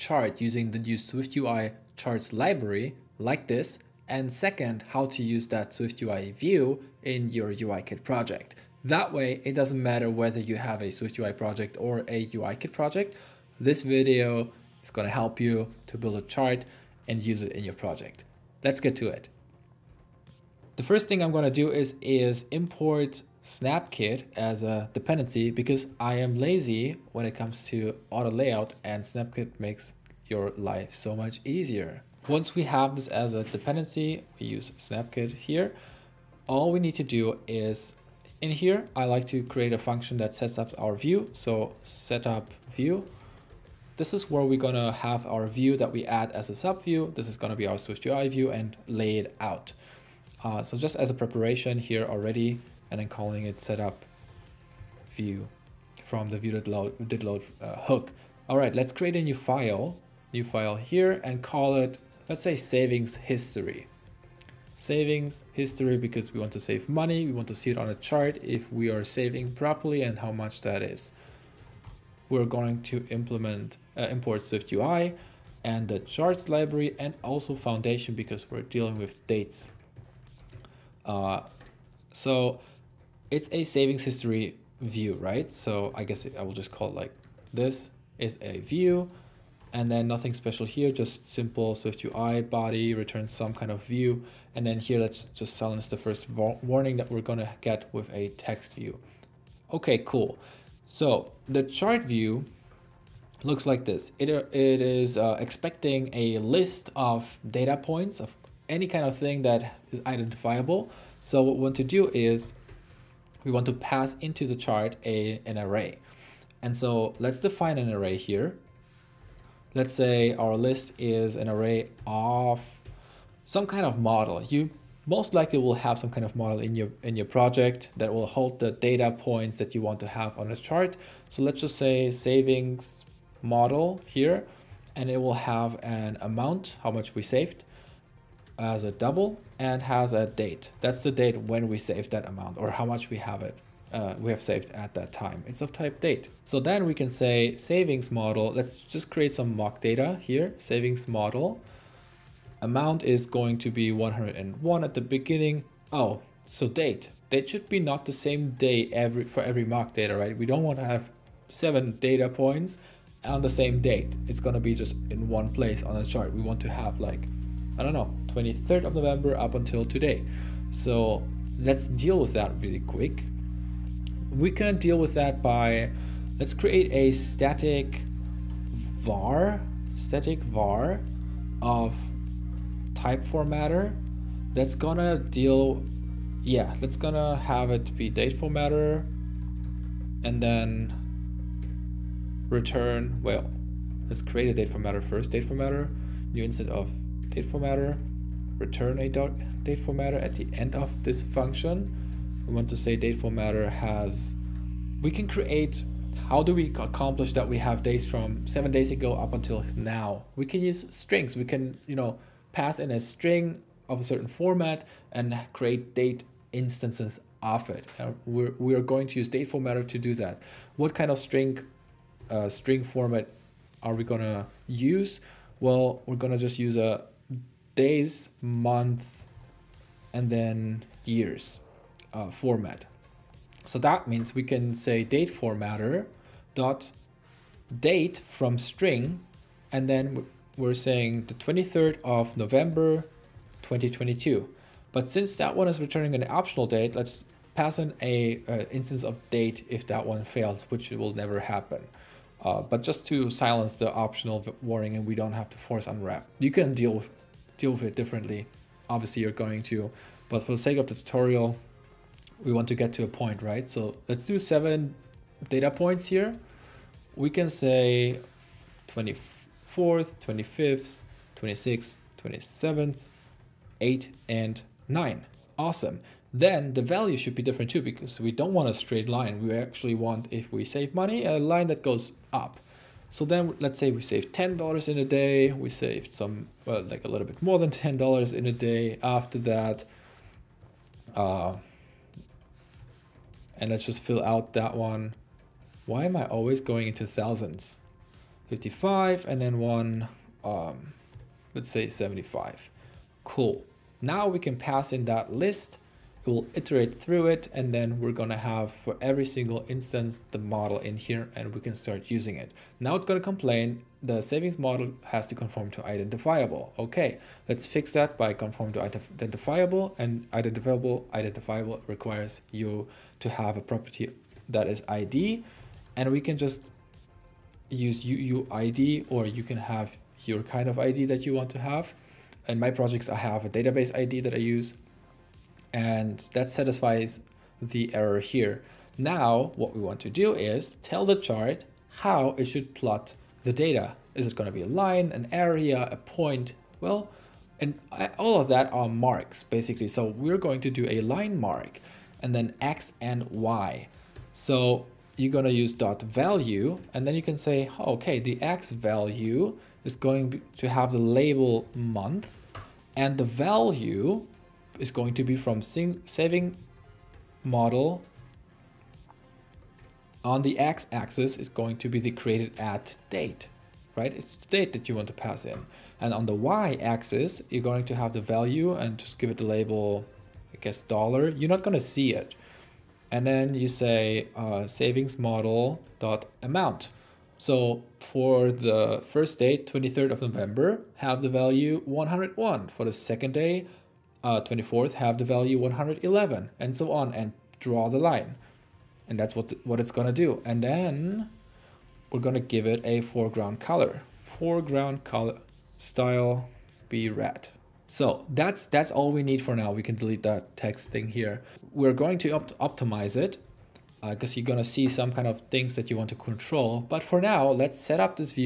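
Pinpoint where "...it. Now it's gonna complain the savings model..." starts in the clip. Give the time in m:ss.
5:12.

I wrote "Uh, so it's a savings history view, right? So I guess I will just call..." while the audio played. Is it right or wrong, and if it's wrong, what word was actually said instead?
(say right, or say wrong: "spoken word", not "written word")
right.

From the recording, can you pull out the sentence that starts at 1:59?
Let's say our list is an array of some kind of model.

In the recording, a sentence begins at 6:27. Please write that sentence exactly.
So for the first day, 23rd of November, have the value 101.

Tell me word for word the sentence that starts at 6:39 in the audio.
And that's what, what it's gonna do.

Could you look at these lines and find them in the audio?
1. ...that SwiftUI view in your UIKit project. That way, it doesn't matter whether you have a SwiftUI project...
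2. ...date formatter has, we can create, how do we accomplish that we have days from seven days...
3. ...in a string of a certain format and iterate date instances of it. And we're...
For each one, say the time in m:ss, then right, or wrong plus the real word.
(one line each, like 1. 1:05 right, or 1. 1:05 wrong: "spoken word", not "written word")
1. 0:05 right
2. 3:22 right
3. 3:32 wrong: "create", not "iterate".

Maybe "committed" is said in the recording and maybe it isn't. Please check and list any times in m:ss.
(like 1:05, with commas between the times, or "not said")
not said.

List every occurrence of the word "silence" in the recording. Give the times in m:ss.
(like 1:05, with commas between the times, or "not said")
1:35, 4:13.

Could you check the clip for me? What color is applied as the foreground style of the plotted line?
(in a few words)
red.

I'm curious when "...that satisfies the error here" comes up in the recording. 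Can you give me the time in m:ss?
5:36.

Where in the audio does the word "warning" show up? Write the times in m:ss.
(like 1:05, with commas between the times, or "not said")
1:36, 4:14.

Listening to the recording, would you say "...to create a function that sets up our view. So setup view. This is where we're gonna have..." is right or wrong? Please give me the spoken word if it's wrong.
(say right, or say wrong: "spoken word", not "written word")
right.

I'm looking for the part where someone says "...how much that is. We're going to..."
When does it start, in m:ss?
1:10.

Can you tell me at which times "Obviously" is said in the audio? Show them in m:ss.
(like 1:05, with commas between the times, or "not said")
4:18.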